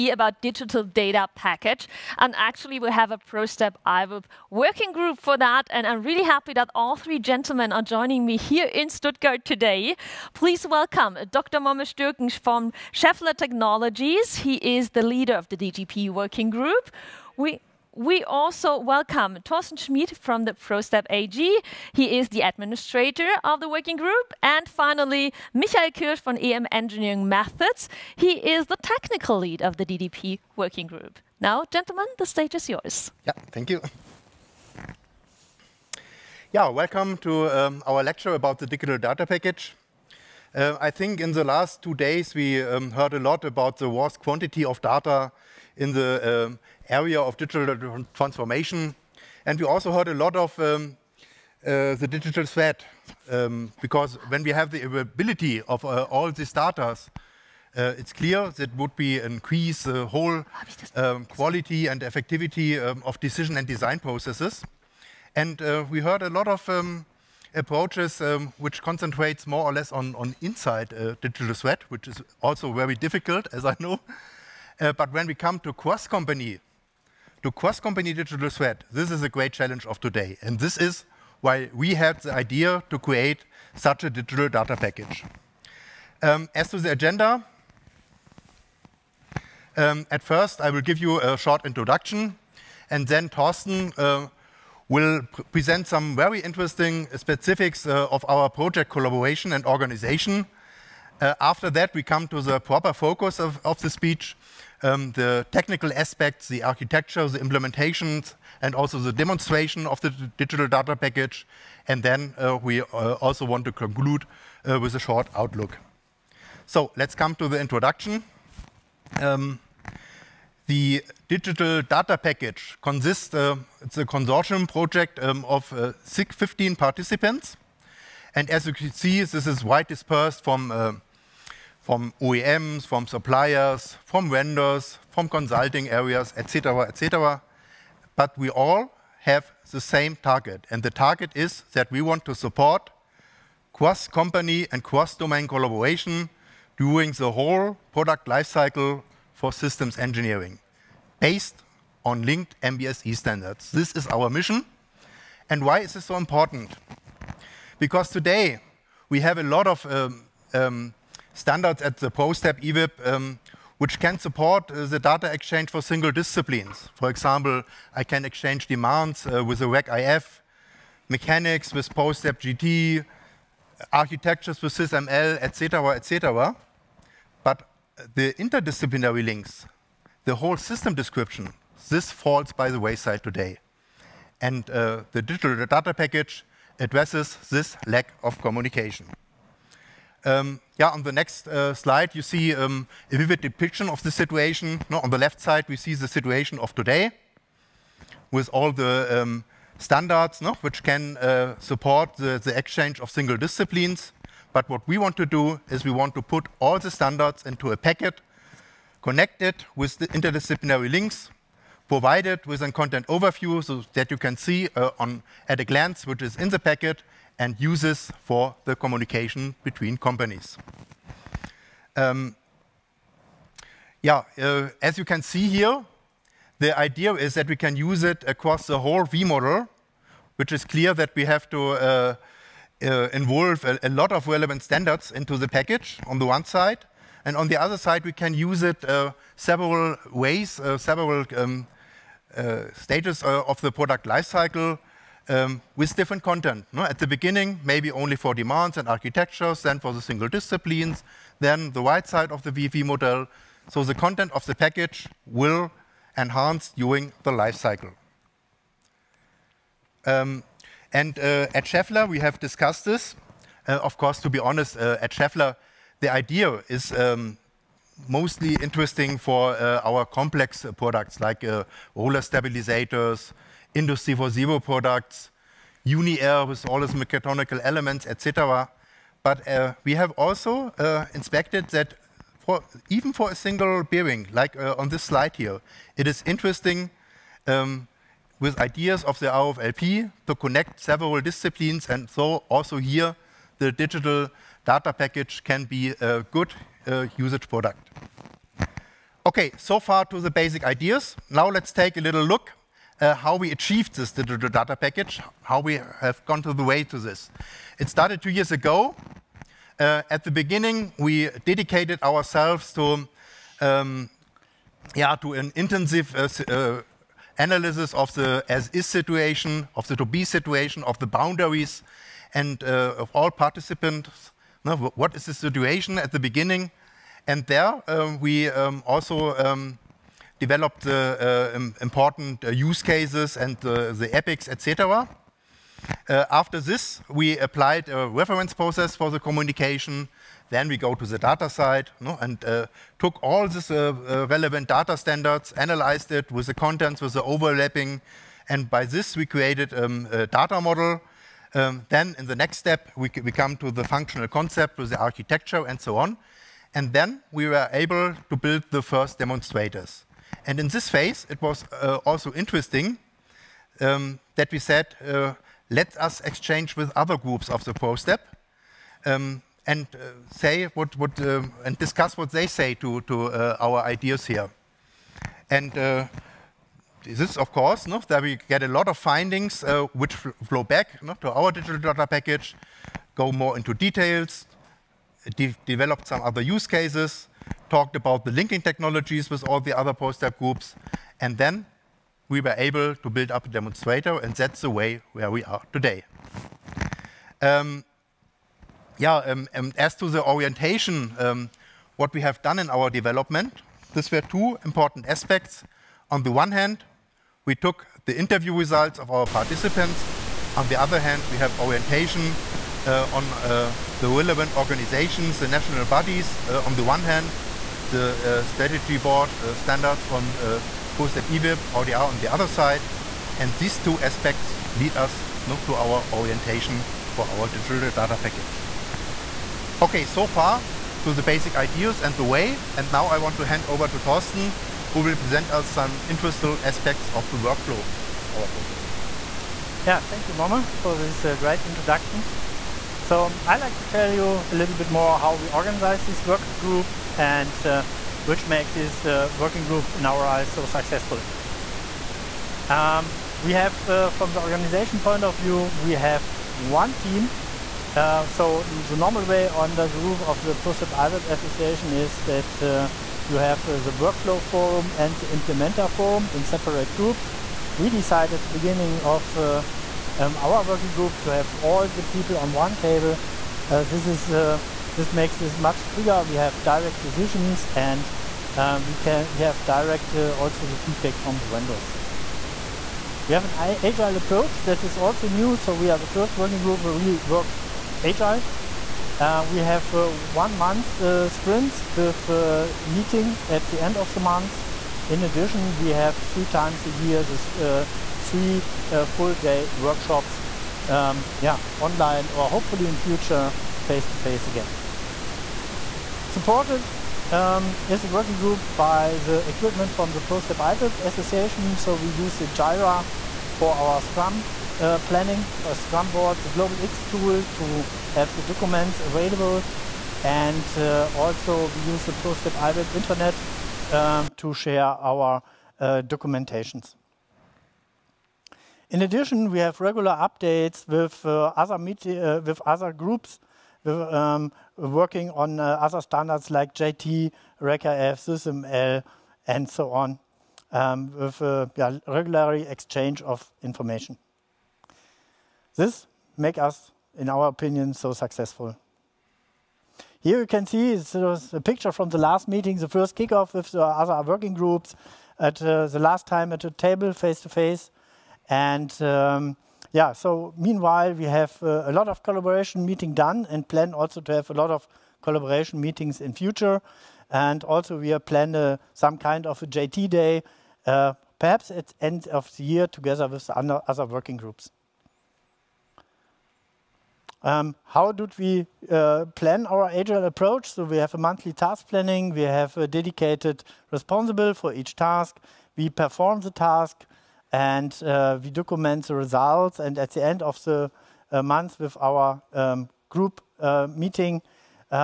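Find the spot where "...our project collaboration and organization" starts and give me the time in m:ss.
1:38.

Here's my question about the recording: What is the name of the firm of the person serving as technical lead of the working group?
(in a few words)
EM Engineering Methods.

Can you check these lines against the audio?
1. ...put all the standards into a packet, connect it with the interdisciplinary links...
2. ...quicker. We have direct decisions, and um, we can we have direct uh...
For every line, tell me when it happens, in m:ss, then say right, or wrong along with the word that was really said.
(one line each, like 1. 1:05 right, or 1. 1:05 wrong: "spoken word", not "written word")
1. 3:26 right
2. 7:55 right.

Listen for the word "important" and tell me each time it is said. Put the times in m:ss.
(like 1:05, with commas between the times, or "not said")
2:36, 5:31, 6:44.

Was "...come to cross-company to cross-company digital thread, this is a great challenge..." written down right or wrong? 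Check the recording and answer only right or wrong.
right.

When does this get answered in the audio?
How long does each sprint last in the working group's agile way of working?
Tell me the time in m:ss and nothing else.
8:10.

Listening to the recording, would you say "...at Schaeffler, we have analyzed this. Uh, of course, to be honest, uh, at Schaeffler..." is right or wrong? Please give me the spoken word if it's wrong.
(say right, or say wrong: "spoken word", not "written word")
wrong: "discussed", not "analyzed".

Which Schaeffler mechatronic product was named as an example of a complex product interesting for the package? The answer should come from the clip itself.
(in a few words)
UniAir.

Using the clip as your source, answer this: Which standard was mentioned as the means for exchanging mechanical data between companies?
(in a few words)
ProStep JT.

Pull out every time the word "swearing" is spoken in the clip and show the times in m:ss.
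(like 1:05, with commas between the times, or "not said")
not said.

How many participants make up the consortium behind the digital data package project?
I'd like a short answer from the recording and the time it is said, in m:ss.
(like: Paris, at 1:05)
15, at 2:06.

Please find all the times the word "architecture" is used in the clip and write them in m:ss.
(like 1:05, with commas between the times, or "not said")
1:46, 2:53, 4:08, 5:54.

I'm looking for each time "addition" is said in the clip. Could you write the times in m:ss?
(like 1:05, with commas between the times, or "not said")
8:15, 8:49.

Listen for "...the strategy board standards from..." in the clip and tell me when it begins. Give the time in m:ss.
6:57.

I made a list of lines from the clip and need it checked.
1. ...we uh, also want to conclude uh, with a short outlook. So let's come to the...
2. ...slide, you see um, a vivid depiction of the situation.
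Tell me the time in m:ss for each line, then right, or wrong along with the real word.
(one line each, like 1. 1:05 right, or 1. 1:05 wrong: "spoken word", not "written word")
1. 1:52 right
2. 3:11 right.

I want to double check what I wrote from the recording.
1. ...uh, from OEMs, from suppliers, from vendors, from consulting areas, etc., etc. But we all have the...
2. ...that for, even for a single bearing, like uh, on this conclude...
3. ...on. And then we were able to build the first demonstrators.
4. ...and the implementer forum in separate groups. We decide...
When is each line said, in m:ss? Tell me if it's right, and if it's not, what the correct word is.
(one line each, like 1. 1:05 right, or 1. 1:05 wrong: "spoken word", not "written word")
1. 2:10 right
2. 4:41 wrong: "slide", not "conclude"
3. 5:55 right
4. 7:44 right.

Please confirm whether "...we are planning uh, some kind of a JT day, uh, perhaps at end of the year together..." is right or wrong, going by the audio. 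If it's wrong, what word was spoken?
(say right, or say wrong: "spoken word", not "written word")
right.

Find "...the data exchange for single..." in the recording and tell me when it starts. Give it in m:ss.
2:44.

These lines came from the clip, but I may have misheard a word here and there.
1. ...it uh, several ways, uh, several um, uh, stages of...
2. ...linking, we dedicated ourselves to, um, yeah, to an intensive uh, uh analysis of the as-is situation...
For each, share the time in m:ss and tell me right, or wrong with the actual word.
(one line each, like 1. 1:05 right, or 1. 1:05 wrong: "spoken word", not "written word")
1. 3:58 right
2. 5:10 wrong: "beginning", not "linking".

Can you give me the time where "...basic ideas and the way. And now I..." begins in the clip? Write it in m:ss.
7:11.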